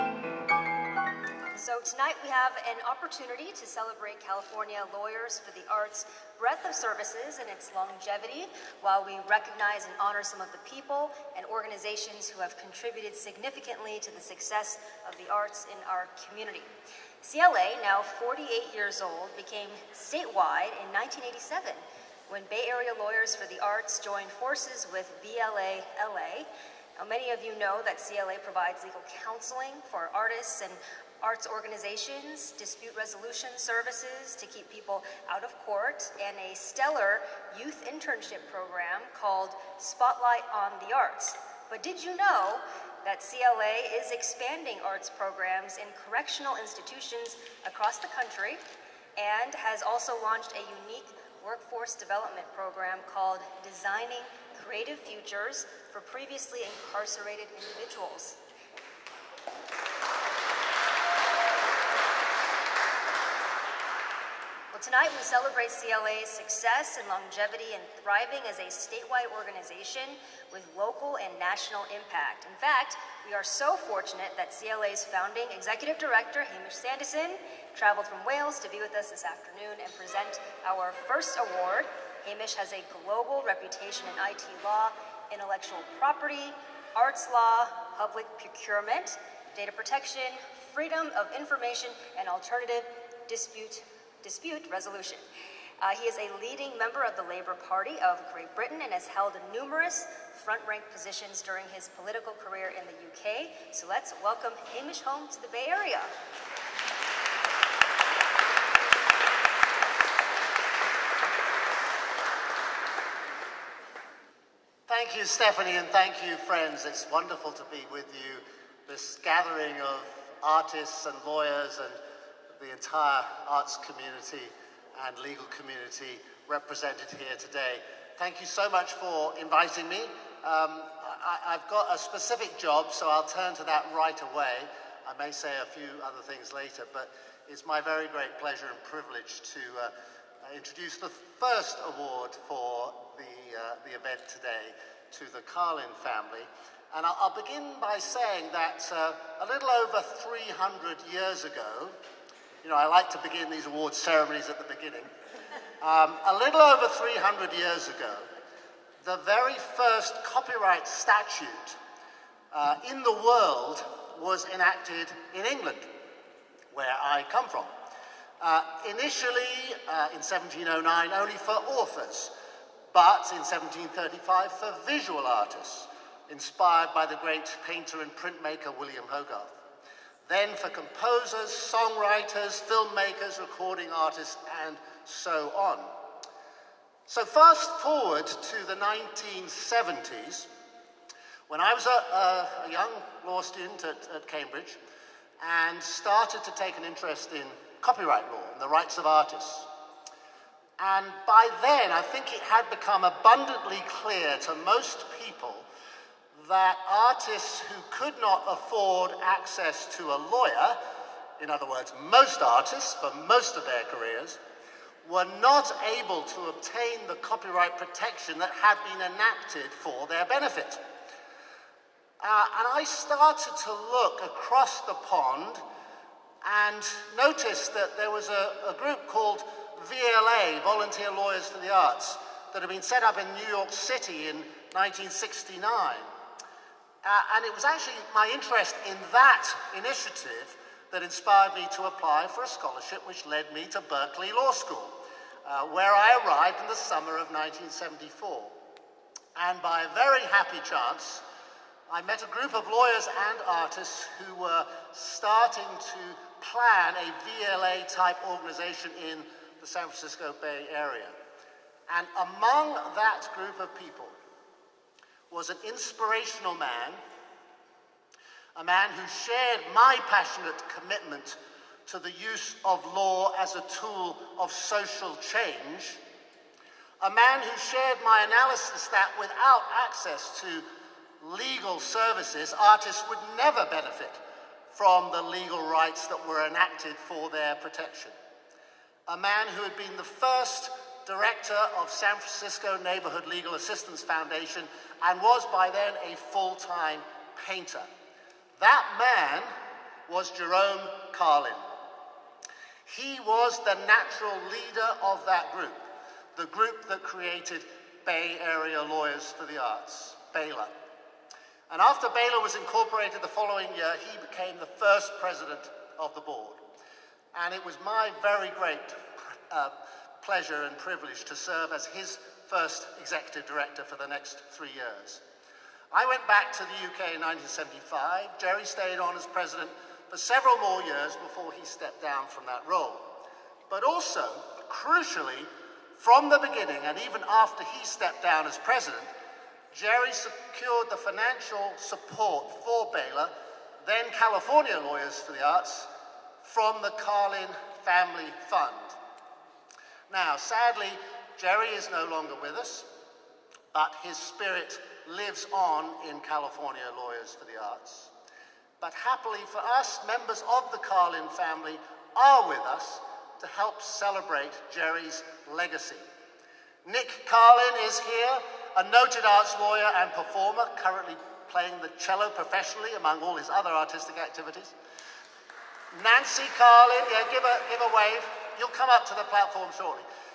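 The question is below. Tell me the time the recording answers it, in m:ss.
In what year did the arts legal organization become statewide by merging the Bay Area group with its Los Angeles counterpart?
0:20.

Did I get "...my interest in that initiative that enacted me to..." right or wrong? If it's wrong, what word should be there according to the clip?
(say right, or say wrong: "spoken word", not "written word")
wrong: "inspired", not "enacted".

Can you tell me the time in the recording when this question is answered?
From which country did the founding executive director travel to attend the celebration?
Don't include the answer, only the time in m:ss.
1:18.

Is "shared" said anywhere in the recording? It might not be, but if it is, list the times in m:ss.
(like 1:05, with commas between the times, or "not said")
4:29, 4:37.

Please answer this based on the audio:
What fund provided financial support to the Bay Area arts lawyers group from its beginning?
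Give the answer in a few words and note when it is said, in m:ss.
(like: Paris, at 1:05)
Carlin Family Fund, at 5:46.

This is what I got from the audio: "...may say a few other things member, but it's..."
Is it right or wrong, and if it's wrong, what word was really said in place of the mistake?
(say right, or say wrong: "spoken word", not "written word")
wrong: "later", not "member".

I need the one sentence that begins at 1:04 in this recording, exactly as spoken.
Tonight, we celebrate CLA's success and longevity and thriving as a statewide organization with local and national impact.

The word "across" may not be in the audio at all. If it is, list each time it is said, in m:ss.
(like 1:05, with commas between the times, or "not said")
0:47, 3:44.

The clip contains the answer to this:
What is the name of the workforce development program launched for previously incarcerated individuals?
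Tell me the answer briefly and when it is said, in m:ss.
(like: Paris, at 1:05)
Designing Creative Futures, at 0:53.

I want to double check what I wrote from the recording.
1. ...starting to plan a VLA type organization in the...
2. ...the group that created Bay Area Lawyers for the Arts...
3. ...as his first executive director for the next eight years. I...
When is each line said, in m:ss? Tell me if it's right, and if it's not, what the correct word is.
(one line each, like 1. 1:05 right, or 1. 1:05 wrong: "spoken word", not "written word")
1. 4:14 right
2. 5:06 right
3. 5:21 wrong: "three", not "eight".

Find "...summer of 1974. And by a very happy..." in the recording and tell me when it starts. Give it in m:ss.
4:06.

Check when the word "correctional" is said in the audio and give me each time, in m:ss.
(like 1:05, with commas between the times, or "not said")
0:46.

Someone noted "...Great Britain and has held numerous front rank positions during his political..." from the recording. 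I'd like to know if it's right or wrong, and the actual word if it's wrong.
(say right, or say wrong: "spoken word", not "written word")
right.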